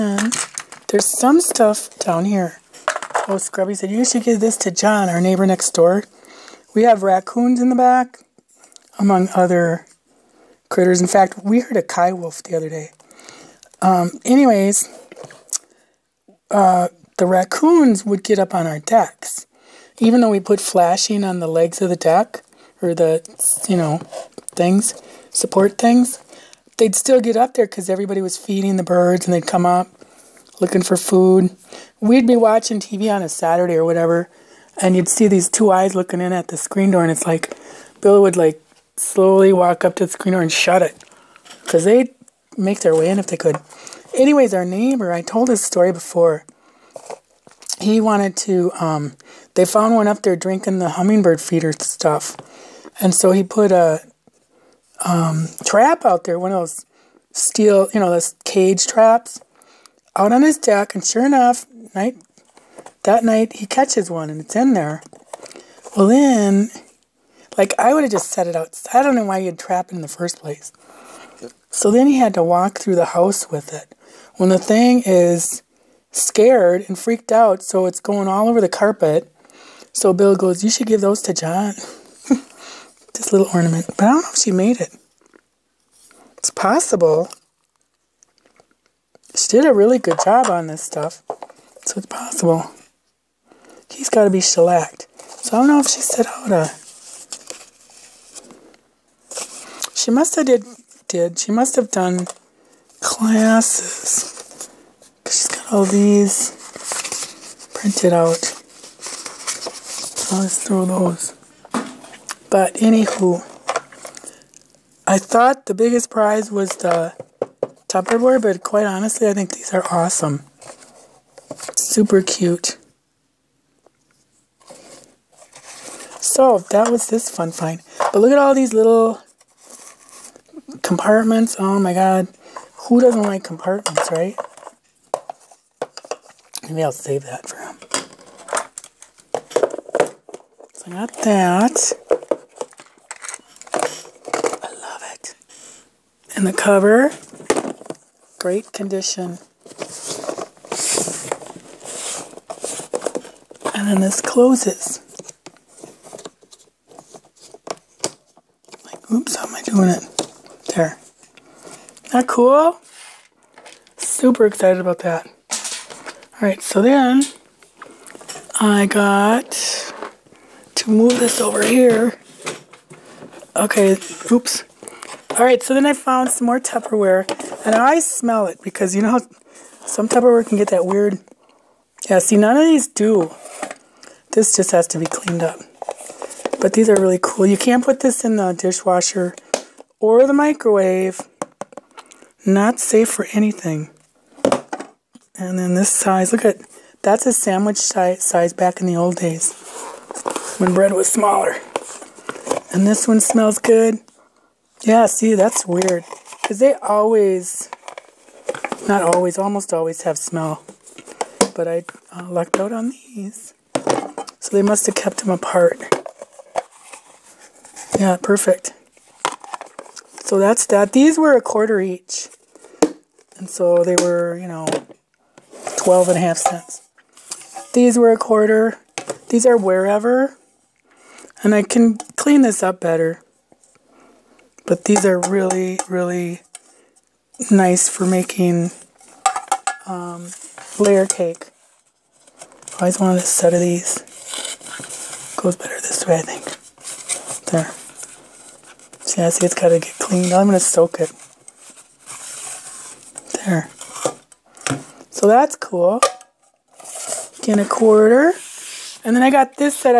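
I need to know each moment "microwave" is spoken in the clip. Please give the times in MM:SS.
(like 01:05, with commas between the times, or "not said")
03:10.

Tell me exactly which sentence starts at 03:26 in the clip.
Because they always, not always, almost always have smell.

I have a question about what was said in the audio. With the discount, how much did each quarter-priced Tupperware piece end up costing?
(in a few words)
12 and a half cents.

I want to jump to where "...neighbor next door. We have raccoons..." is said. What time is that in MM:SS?
00:05.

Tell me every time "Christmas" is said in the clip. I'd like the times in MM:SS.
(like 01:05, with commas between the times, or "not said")
not said.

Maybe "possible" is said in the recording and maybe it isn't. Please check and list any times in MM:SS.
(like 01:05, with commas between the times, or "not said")
01:26, 01:32.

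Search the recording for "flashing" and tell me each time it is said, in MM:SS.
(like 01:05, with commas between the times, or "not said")
00:20.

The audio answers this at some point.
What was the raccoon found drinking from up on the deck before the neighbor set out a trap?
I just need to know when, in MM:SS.
00:50.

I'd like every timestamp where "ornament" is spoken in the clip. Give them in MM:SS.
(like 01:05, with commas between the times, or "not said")
01:23.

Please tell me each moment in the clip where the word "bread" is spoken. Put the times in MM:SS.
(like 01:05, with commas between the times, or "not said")
03:20.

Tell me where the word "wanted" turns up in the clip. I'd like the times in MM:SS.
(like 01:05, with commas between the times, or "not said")
00:48, 04:03.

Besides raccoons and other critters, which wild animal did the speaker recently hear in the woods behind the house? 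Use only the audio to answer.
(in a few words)
coywolf.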